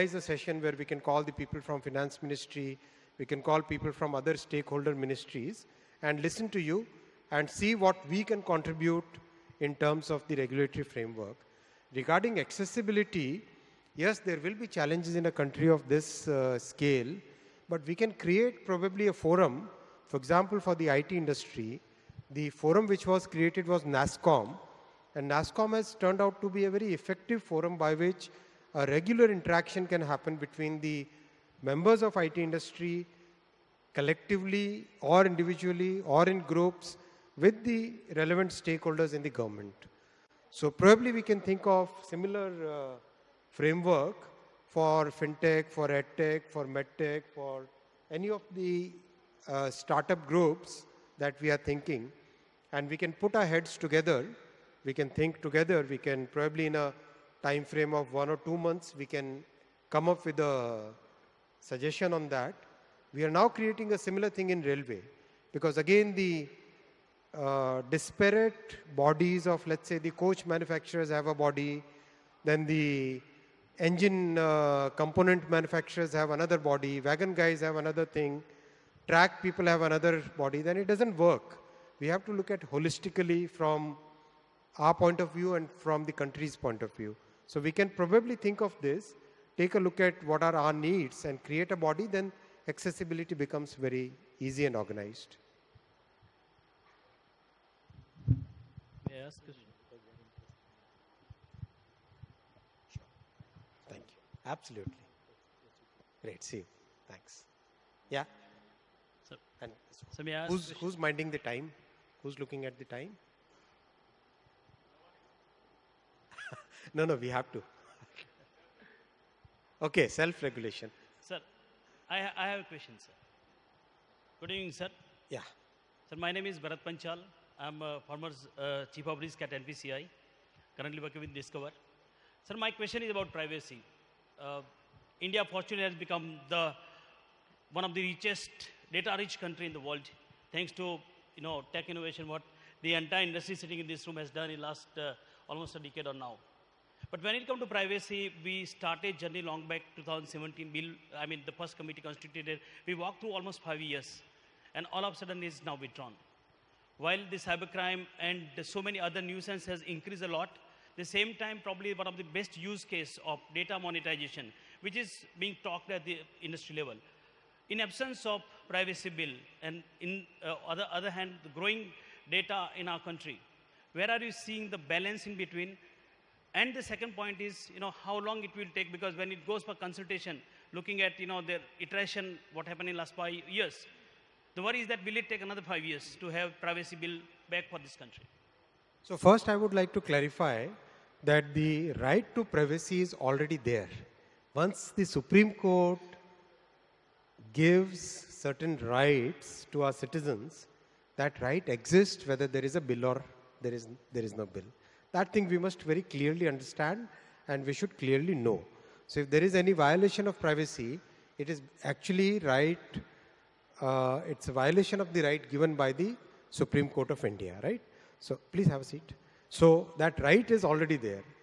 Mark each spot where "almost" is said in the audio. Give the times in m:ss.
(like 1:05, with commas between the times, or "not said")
2:25, 2:33.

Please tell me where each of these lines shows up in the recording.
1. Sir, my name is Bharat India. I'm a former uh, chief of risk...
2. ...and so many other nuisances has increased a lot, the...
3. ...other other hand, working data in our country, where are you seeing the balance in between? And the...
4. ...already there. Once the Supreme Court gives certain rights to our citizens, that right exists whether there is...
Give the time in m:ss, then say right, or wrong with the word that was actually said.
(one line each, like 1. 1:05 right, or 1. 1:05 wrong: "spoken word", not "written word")
1. 2:06 wrong: "Panchal", not "India"
2. 2:38 right
3. 2:50 wrong: "growing", not "working"
4. 3:13 right.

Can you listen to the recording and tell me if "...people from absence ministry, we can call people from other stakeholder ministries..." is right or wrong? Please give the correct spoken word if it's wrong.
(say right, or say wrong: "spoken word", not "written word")
wrong: "finance", not "absence".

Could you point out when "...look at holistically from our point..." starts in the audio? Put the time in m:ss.
1:22.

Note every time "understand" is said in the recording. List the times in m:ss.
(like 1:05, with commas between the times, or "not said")
3:26.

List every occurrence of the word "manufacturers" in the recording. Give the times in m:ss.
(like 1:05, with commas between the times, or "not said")
1:10, 1:15.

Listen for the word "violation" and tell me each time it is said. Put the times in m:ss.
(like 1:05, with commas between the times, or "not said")
3:29, 3:34.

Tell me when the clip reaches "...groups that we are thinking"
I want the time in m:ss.
0:50.